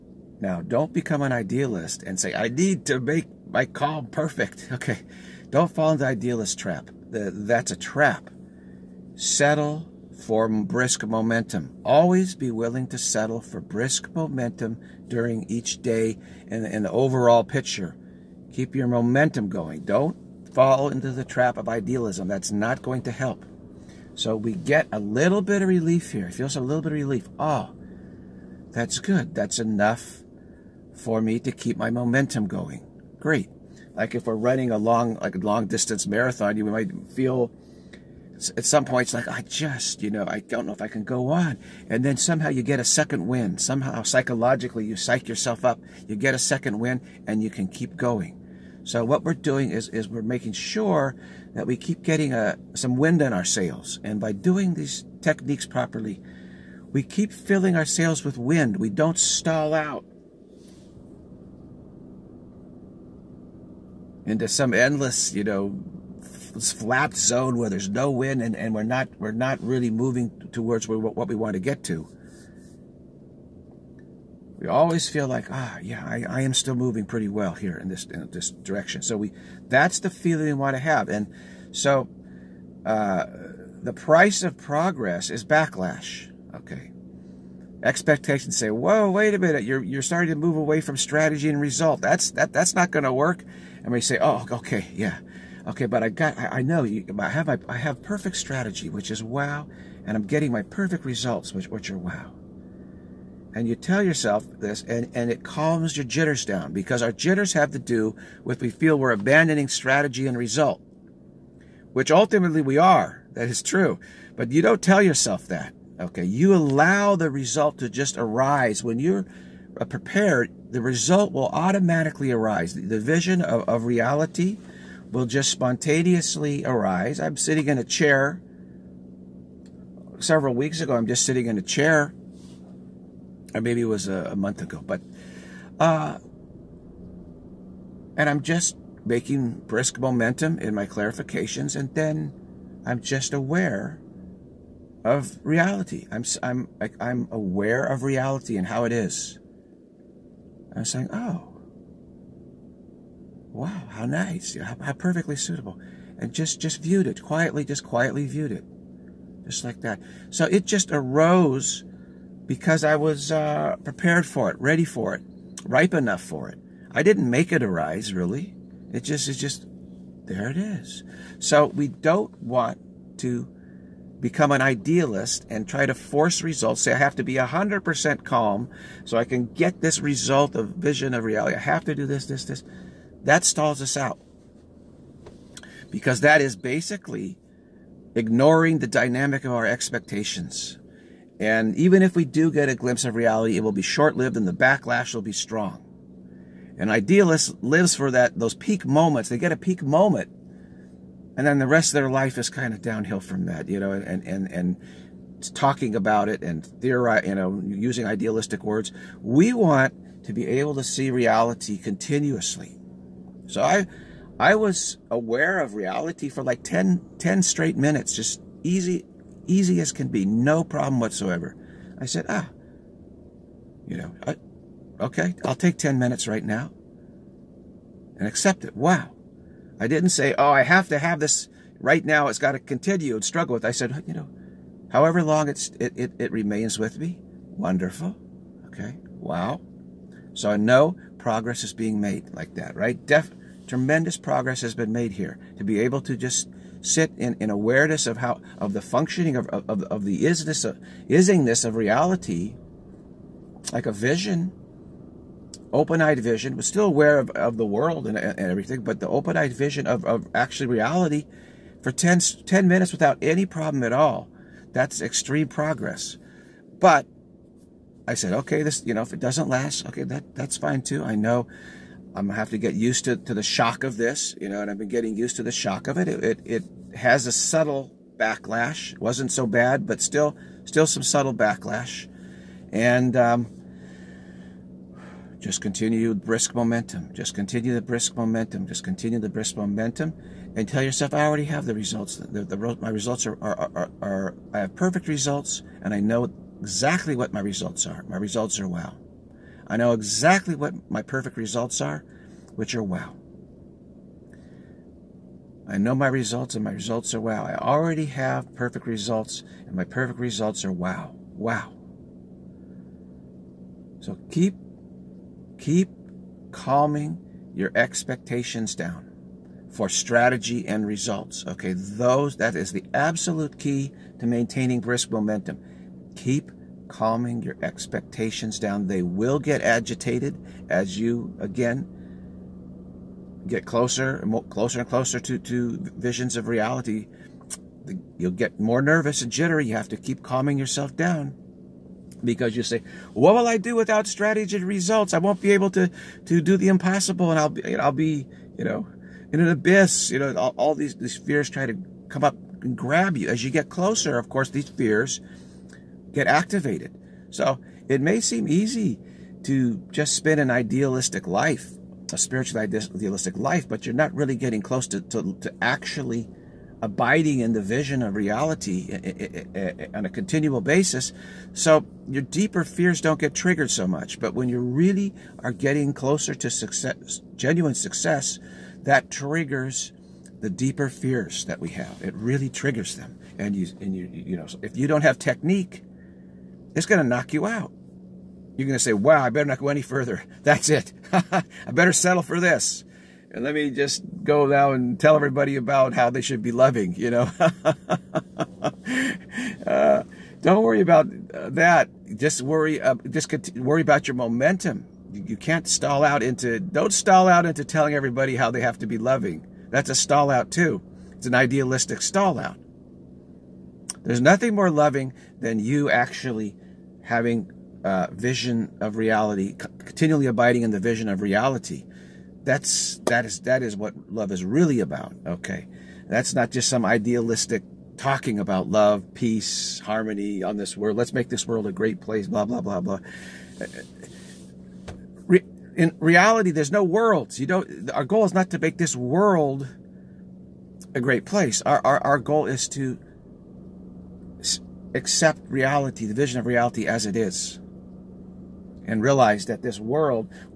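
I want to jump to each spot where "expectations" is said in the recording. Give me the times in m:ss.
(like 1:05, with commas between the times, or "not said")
1:27, 3:09, 5:17, 5:27.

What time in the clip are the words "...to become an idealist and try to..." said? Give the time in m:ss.
2:53.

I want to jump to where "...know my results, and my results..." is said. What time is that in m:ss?
5:05.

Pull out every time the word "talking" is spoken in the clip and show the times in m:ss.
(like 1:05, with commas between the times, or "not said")
3:25, 7:07.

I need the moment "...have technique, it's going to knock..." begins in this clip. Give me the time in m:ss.
6:25.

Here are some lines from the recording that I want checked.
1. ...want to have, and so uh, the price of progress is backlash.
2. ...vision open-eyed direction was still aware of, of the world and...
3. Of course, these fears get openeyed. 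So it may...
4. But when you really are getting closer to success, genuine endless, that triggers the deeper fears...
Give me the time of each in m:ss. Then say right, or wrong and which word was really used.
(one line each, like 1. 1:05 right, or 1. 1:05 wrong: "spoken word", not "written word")
1. 1:20 right
2. 4:13 wrong: "vision", not "direction"
3. 5:54 wrong: "activated", not "openeyed"
4. 6:14 wrong: "success", not "endless".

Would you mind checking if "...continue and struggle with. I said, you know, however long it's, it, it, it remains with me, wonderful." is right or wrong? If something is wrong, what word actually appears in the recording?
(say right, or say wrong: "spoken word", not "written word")
right.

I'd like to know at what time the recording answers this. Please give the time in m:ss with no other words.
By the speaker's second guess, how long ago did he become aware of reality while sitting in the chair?
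2:14.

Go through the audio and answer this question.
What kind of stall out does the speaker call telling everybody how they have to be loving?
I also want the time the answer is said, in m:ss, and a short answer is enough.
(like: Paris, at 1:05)
idealistic stall out, at 6:51.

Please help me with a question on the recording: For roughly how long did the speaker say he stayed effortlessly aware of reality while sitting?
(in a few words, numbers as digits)
10 minutes.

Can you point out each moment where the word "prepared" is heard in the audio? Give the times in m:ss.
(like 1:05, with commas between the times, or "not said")
1:59, 2:43.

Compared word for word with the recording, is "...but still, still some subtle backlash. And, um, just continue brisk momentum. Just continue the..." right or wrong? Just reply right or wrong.
right.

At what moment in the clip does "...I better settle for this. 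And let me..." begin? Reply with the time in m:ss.
6:31.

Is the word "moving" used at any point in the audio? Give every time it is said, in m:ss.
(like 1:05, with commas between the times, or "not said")
1:09, 1:16.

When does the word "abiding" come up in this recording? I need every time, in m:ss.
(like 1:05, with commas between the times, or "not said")
6:06, 7:00.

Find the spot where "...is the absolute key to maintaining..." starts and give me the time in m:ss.
5:22.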